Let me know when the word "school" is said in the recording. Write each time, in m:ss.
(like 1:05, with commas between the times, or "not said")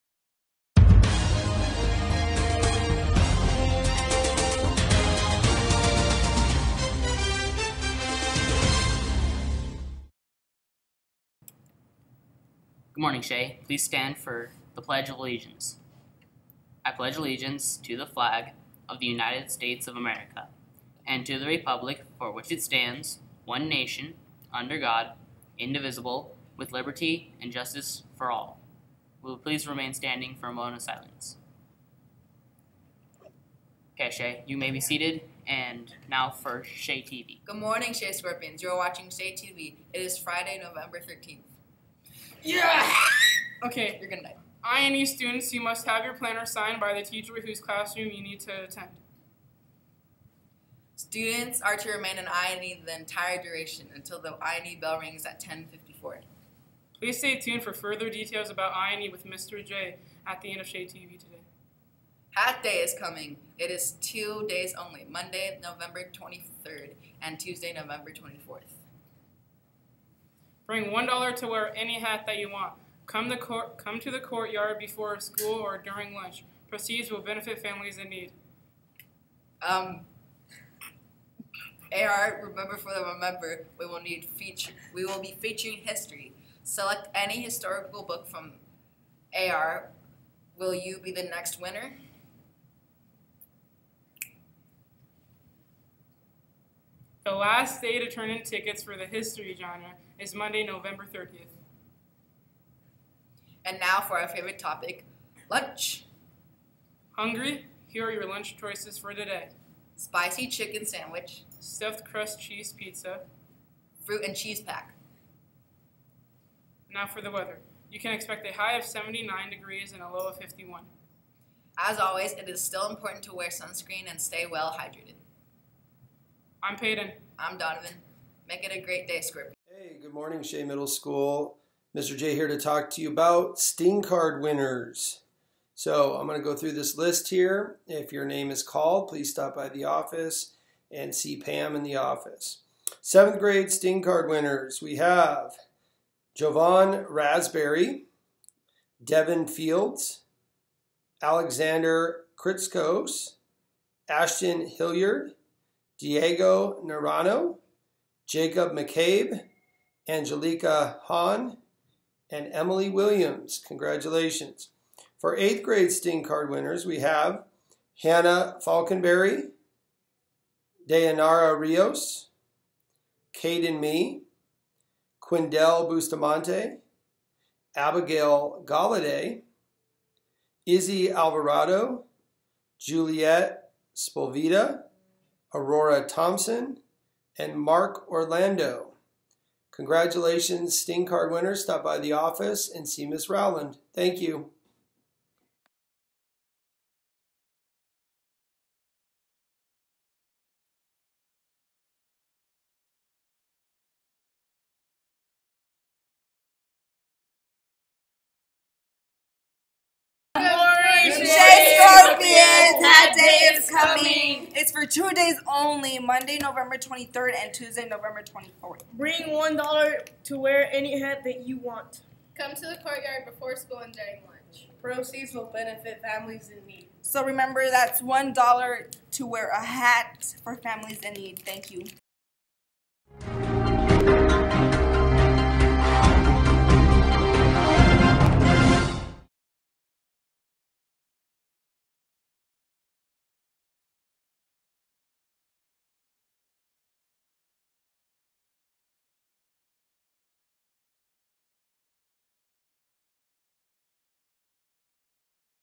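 1:15, 2:10, 3:43.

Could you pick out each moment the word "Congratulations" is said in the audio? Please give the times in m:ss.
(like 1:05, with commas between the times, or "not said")
2:43, 3:09.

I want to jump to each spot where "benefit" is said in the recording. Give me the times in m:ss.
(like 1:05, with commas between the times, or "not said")
1:17, 3:45.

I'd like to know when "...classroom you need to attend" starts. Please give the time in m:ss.
0:47.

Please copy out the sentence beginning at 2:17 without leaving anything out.
If your name is called, please stop by the office and see Pam in the office.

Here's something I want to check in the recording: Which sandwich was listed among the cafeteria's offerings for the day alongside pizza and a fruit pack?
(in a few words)
Spicy chicken sandwich.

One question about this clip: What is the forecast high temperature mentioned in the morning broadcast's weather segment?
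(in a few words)
79 degrees.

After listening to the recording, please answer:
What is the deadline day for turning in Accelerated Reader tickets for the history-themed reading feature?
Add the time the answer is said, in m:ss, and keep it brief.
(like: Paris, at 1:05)
Monday, November 30th, at 1:40.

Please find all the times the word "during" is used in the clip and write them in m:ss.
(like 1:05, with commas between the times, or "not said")
1:15, 3:43.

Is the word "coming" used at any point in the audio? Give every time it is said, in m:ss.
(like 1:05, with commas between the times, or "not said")
1:02, 3:33.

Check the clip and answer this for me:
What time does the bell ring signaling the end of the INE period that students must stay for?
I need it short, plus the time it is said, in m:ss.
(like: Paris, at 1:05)
10:54, at 0:55.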